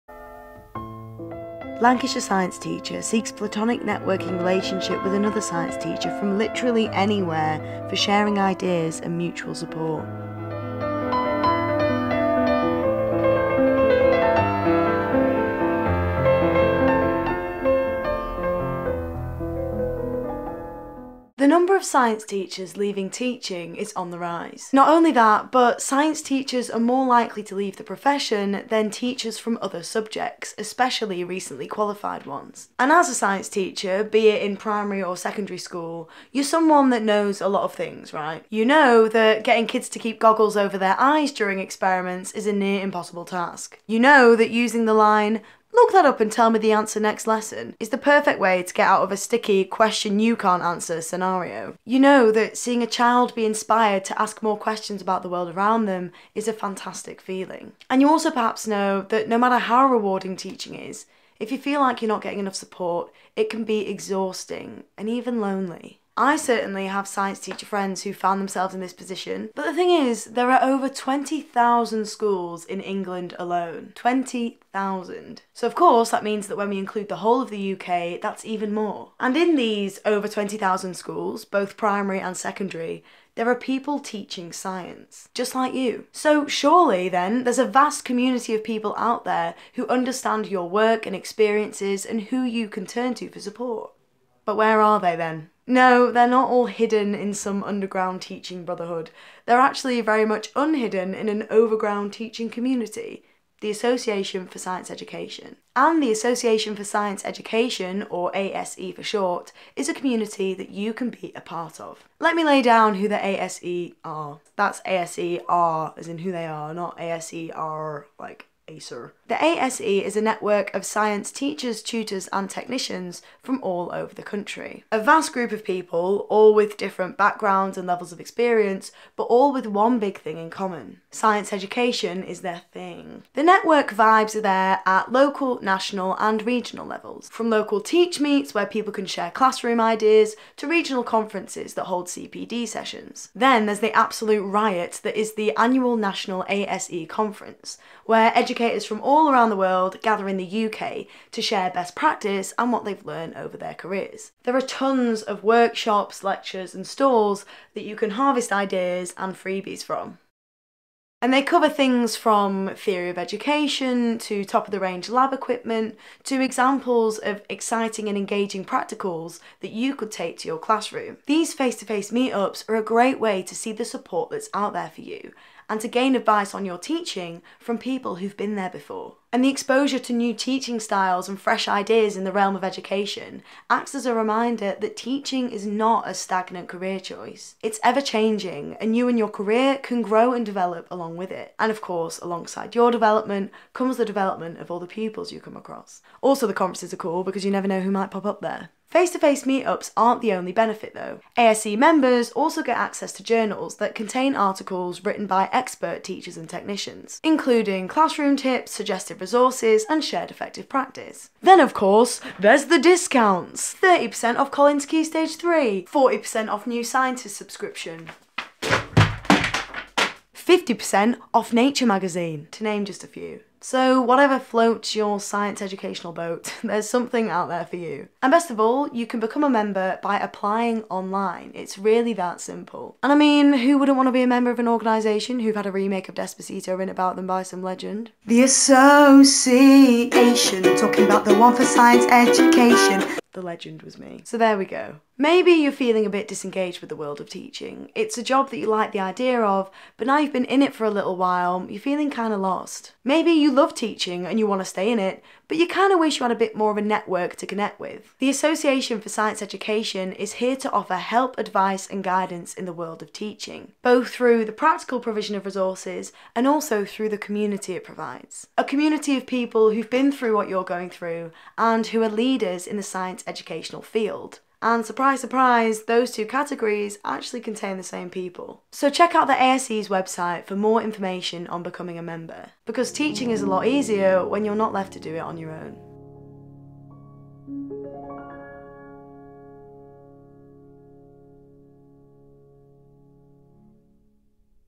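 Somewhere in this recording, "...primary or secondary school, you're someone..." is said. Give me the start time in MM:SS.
00:34.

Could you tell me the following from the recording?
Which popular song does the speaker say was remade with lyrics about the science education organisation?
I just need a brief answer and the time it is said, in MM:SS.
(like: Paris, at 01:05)
Despacito, at 03:56.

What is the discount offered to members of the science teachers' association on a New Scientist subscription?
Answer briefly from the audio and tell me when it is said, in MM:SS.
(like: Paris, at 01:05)
40%, at 03:35.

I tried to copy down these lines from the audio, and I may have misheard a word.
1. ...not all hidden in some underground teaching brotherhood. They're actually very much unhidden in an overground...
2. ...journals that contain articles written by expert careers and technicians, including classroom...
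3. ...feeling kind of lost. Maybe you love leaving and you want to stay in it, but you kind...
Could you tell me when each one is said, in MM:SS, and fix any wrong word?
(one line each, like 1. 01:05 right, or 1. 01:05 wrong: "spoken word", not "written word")
1. 01:36 right
2. 03:23 wrong: "teachers", not "careers"
3. 04:11 wrong: "teaching", not "leaving".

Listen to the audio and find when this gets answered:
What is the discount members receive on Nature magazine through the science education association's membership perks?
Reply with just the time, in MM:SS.
03:40.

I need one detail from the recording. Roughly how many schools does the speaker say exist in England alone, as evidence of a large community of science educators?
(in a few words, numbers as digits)
20,000.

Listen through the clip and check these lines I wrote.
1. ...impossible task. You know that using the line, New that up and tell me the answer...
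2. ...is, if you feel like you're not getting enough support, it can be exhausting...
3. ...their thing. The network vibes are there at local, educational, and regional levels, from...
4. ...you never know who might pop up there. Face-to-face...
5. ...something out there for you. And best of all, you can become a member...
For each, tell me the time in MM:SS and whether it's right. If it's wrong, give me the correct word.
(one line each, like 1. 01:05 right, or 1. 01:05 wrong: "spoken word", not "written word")
1. 00:42 wrong: "Look", not "New"
2. 01:00 right
3. 02:12 wrong: "national", not "educational"
4. 03:17 right
5. 03:46 right.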